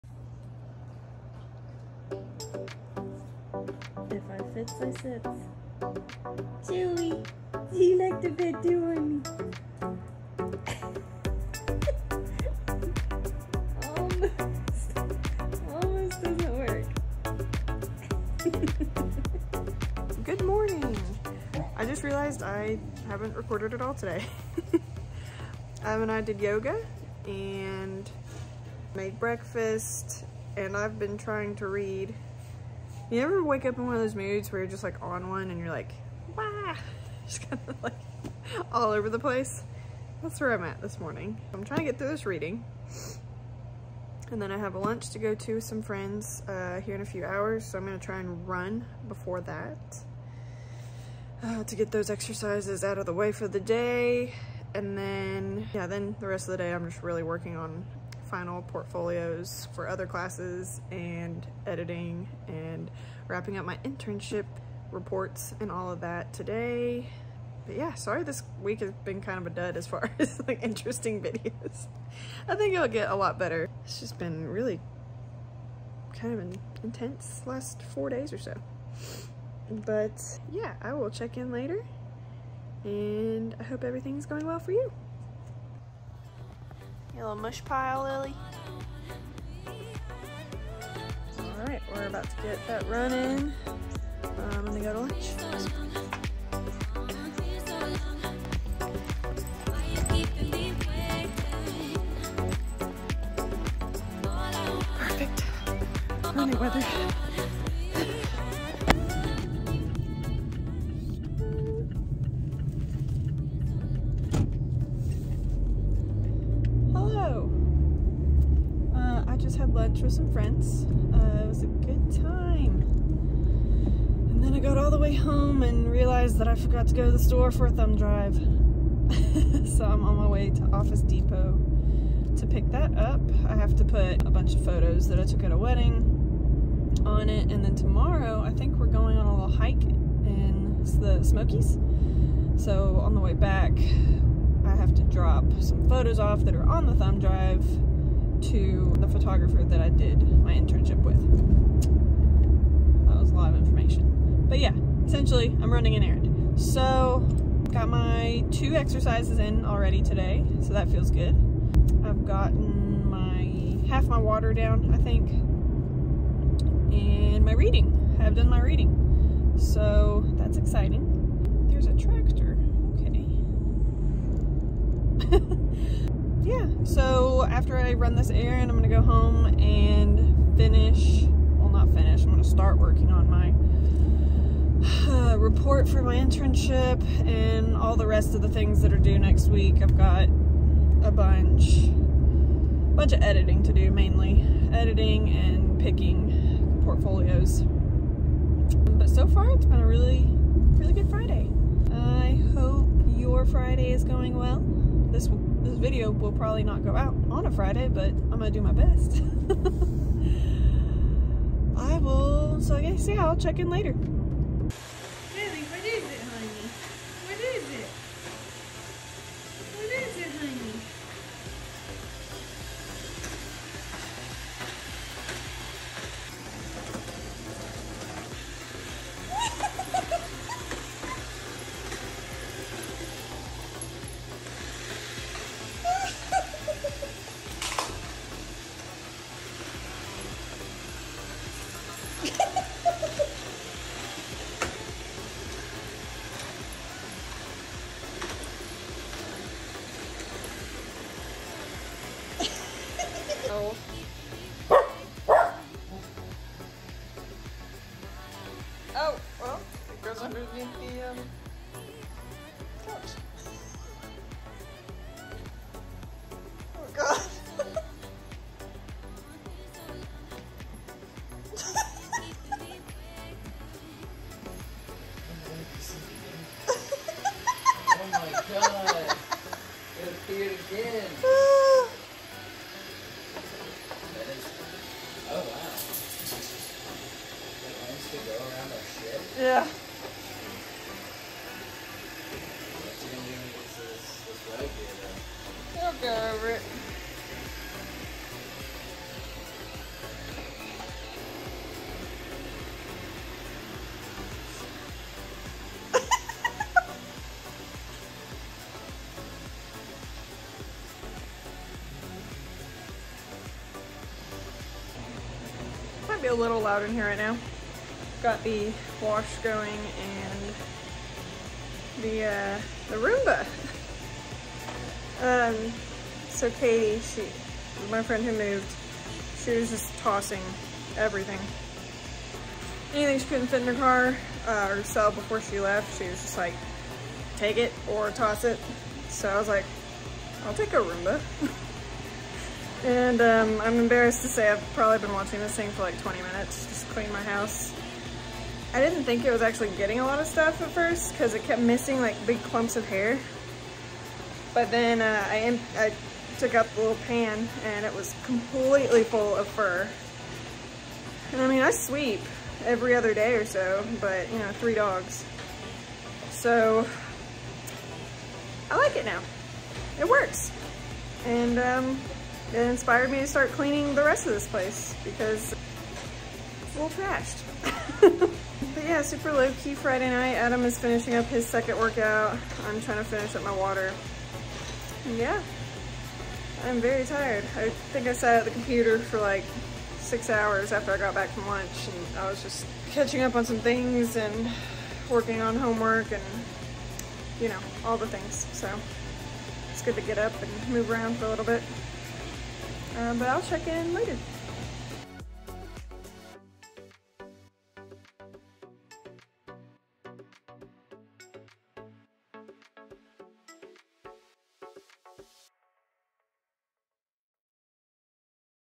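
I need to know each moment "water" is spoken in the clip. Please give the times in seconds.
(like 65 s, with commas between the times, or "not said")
164 s, 383 s.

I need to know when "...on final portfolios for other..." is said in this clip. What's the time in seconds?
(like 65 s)
57 s.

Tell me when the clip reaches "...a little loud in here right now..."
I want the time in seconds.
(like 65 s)
316 s.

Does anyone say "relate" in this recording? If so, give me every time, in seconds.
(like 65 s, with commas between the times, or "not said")
not said.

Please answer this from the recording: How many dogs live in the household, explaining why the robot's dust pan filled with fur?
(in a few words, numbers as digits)
3.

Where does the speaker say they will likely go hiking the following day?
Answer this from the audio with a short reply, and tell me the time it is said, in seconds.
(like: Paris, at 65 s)
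the Smokies, at 141 s.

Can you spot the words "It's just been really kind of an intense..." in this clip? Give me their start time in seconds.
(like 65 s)
73 s.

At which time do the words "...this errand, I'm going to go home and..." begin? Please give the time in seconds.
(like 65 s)
178 s.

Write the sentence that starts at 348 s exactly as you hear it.
I didn't think it was actually getting a lot of stuff at first because it kept missing like big clumps of hair.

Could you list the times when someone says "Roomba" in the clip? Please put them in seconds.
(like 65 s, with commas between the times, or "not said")
322 s, 340 s.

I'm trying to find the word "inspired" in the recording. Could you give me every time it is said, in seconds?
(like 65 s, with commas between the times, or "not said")
372 s.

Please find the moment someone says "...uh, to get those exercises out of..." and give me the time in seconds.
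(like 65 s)
51 s.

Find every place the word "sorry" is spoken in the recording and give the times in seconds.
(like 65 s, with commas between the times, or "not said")
67 s.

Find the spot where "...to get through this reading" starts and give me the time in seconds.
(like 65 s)
41 s.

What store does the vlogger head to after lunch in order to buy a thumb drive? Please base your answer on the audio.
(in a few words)
Office Depot.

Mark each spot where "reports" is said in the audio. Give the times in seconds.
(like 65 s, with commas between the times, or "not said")
64 s, 185 s.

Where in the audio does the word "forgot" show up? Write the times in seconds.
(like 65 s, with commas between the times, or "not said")
126 s.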